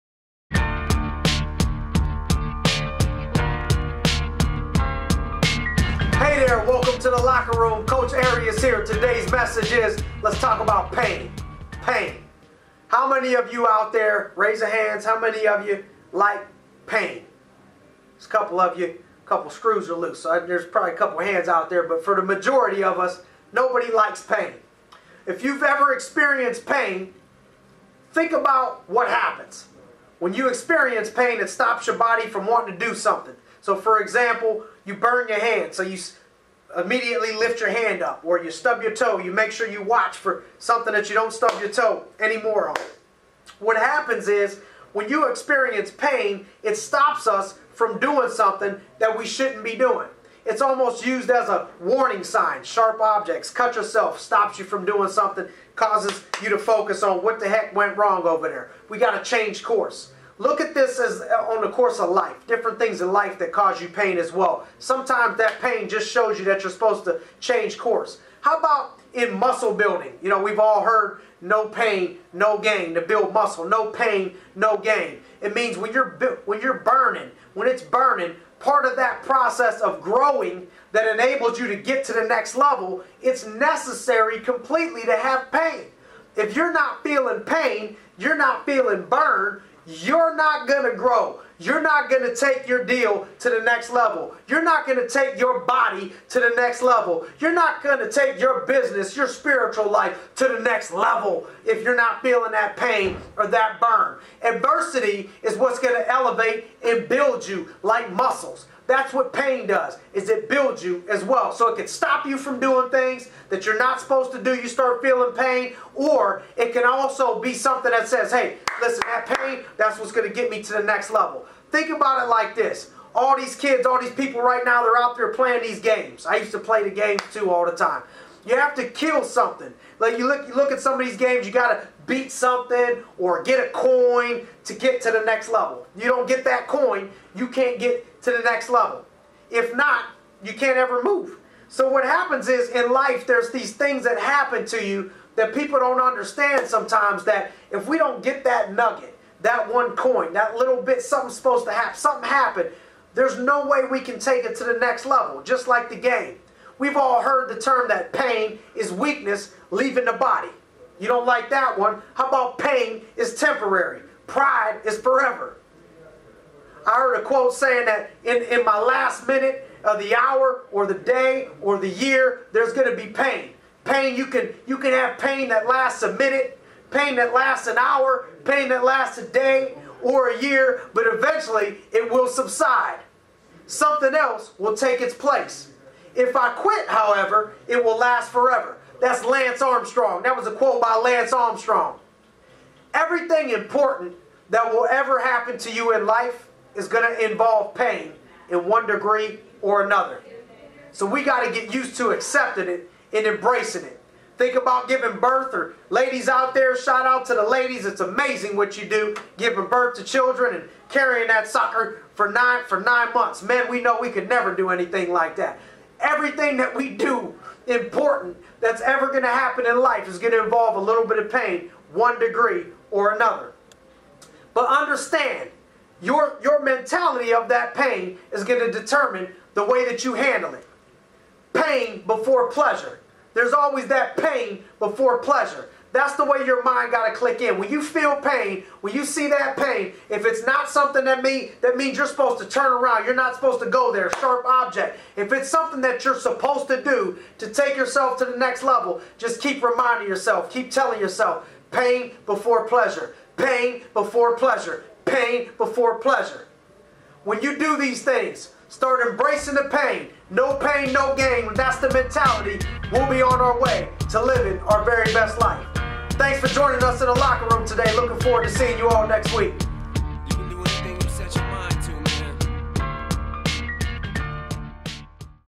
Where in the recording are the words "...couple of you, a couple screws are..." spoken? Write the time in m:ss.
0:18.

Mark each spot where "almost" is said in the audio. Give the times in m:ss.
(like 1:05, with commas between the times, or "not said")
0:50.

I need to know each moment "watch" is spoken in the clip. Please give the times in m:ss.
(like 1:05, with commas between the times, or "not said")
0:39.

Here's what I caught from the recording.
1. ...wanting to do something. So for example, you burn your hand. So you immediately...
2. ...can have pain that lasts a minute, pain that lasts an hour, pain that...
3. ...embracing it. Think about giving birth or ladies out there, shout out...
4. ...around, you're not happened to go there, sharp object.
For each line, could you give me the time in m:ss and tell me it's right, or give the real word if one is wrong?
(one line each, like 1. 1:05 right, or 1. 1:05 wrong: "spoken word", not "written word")
1. 0:32 right
2. 2:54 right
3. 3:23 right
4. 4:02 wrong: "supposed", not "happened".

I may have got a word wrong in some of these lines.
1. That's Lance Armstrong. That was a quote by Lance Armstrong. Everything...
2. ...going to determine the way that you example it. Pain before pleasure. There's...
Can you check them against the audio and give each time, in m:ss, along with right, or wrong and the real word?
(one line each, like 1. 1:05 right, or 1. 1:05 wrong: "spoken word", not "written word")
1. 3:08 right
2. 3:48 wrong: "handle", not "example".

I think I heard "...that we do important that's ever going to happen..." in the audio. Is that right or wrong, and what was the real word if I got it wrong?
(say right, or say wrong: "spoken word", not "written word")
right.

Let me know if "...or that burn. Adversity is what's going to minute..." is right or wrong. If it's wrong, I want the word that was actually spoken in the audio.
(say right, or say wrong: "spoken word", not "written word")
wrong: "elevate", not "minute".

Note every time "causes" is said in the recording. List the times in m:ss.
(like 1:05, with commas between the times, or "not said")
0:55, 1:03.